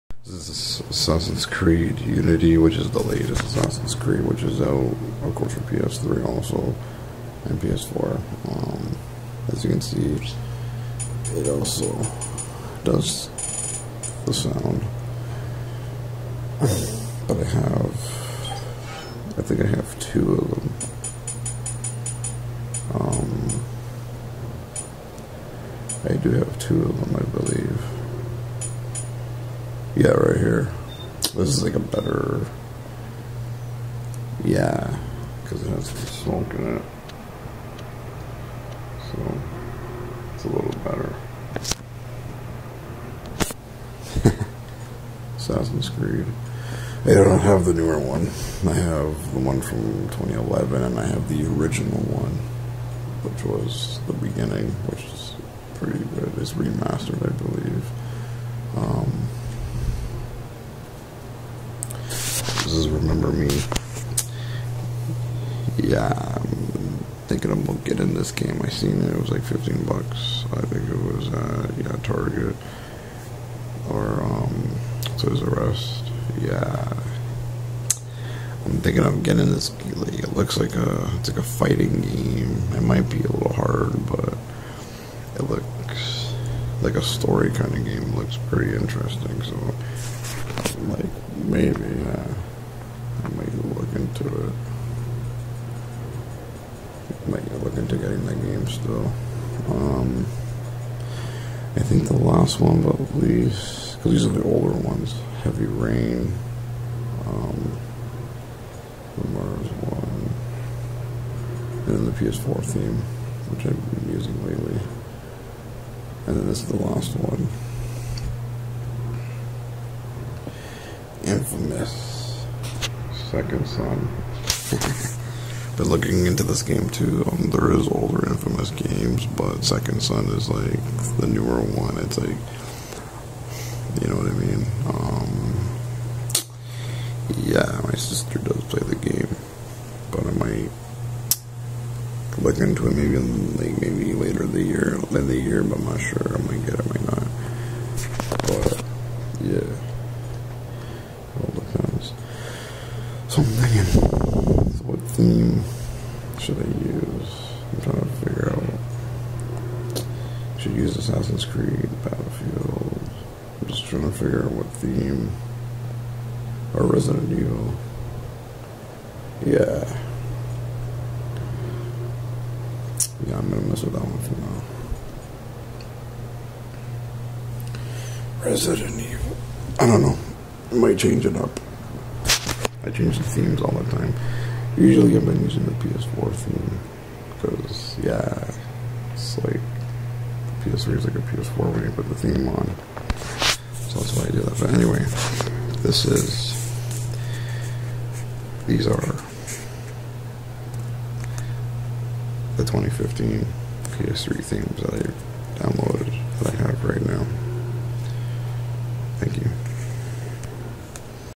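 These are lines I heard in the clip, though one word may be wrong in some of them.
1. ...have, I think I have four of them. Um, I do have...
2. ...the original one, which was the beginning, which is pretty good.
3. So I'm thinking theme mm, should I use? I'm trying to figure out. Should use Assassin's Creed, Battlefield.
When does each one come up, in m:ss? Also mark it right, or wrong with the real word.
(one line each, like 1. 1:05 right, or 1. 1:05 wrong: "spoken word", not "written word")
1. 0:17 wrong: "two", not "four"
2. 0:51 right
3. 2:33 right.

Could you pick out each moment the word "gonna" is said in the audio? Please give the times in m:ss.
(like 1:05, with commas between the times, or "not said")
1:07, 2:53.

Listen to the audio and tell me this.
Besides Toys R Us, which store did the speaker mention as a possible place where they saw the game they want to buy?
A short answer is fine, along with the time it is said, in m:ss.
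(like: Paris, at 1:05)
Target, at 1:12.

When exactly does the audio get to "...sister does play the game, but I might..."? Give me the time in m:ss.
2:17.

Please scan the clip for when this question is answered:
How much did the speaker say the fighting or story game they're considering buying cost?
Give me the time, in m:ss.
1:09.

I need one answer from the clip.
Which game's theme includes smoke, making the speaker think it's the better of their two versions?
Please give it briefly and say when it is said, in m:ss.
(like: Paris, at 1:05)
Assassin's Creed Unity, at 0:00.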